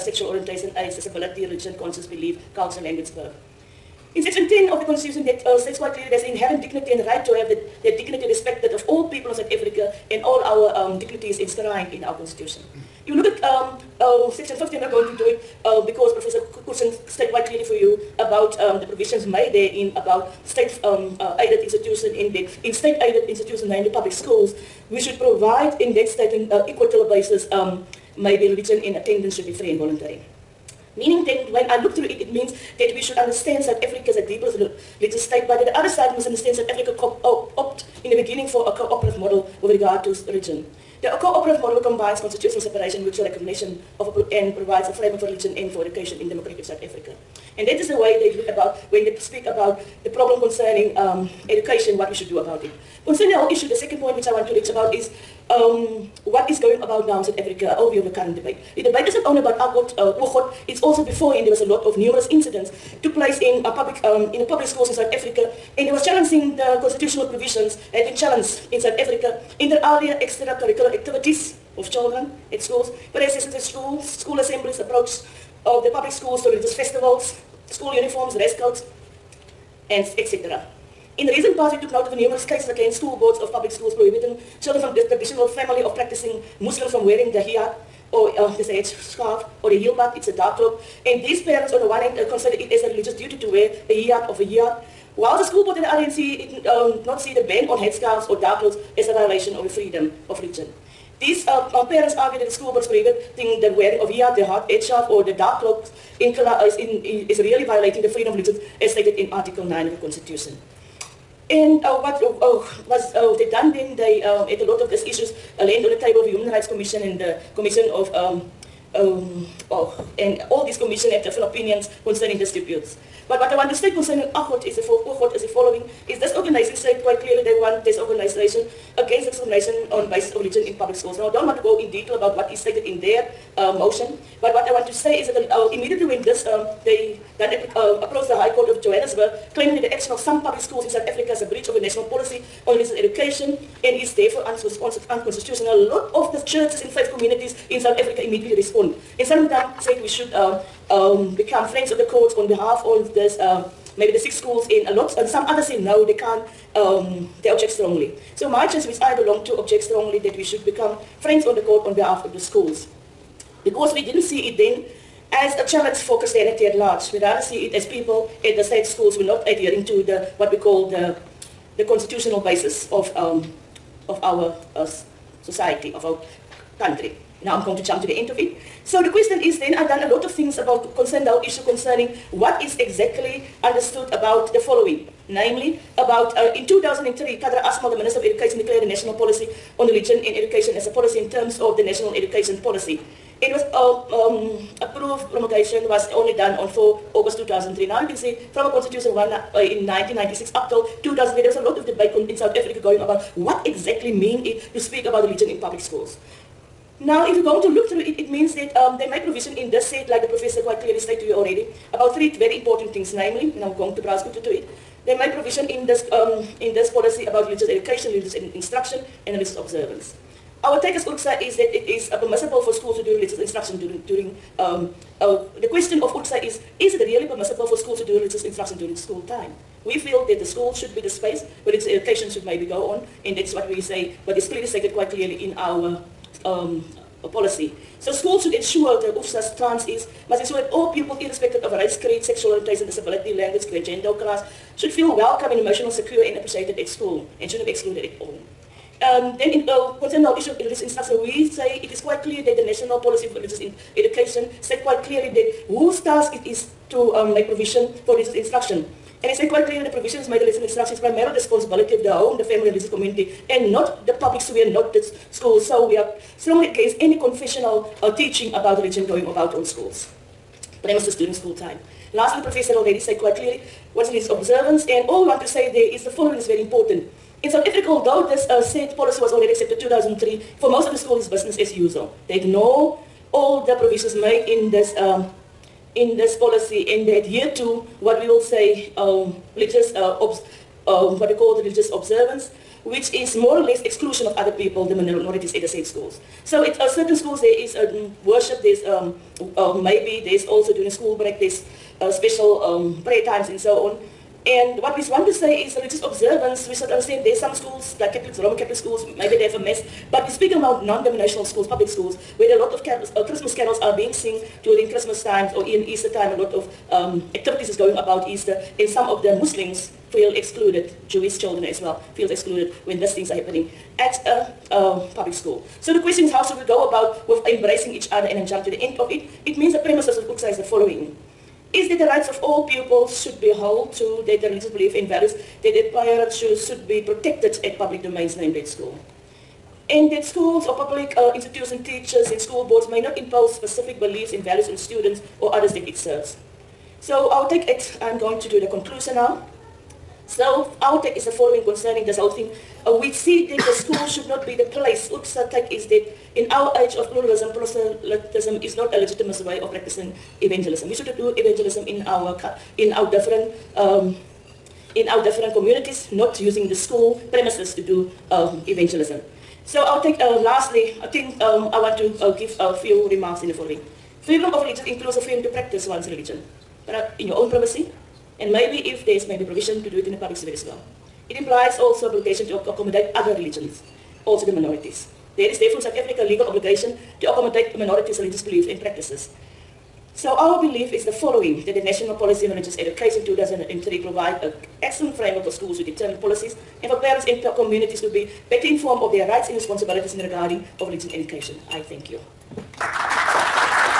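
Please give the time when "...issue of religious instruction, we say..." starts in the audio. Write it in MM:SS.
04:10.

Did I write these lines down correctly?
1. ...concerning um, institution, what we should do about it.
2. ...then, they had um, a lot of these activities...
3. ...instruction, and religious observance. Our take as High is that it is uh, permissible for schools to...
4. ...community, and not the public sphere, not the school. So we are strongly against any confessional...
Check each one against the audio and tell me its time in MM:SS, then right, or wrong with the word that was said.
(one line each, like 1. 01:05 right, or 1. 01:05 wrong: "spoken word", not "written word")
1. 00:50 wrong: "education", not "institution"
2. 01:53 wrong: "issues", not "activities"
3. 03:38 wrong: "URCSA", not "High"
4. 04:22 right.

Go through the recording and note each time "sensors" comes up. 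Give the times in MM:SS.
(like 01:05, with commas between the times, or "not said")
not said.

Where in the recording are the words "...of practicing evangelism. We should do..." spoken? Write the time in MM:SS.
05:59.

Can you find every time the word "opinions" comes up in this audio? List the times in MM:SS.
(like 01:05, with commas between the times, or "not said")
02:01.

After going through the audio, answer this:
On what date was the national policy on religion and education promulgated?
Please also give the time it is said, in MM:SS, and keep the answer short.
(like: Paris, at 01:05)
4 August 2003, at 03:16.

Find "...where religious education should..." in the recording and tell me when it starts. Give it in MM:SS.
03:51.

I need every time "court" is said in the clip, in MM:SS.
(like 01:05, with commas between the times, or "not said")
02:18, 02:32, 02:41.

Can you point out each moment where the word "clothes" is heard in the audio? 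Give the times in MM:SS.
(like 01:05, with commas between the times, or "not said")
01:38, 01:45.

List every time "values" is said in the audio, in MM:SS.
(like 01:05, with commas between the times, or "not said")
05:35, 05:44.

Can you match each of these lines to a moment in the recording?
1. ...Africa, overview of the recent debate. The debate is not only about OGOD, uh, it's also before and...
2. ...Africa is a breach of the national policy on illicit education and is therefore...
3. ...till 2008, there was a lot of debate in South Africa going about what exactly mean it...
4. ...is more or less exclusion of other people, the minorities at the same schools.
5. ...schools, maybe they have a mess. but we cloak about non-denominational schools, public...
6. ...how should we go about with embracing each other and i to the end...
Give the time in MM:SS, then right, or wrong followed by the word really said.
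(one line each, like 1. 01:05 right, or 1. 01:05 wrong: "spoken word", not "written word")
1. 00:57 wrong: "current", not "recent"
2. 02:21 right
3. 03:20 right
4. 04:53 right
5. 05:08 wrong: "speak", not "cloak"
6. 05:26 right.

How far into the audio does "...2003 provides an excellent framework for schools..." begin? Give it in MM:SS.
06:33.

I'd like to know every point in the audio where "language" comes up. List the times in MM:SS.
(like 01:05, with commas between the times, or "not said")
00:02, 04:03.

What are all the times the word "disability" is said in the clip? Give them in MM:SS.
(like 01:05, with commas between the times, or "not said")
00:00, 04:02.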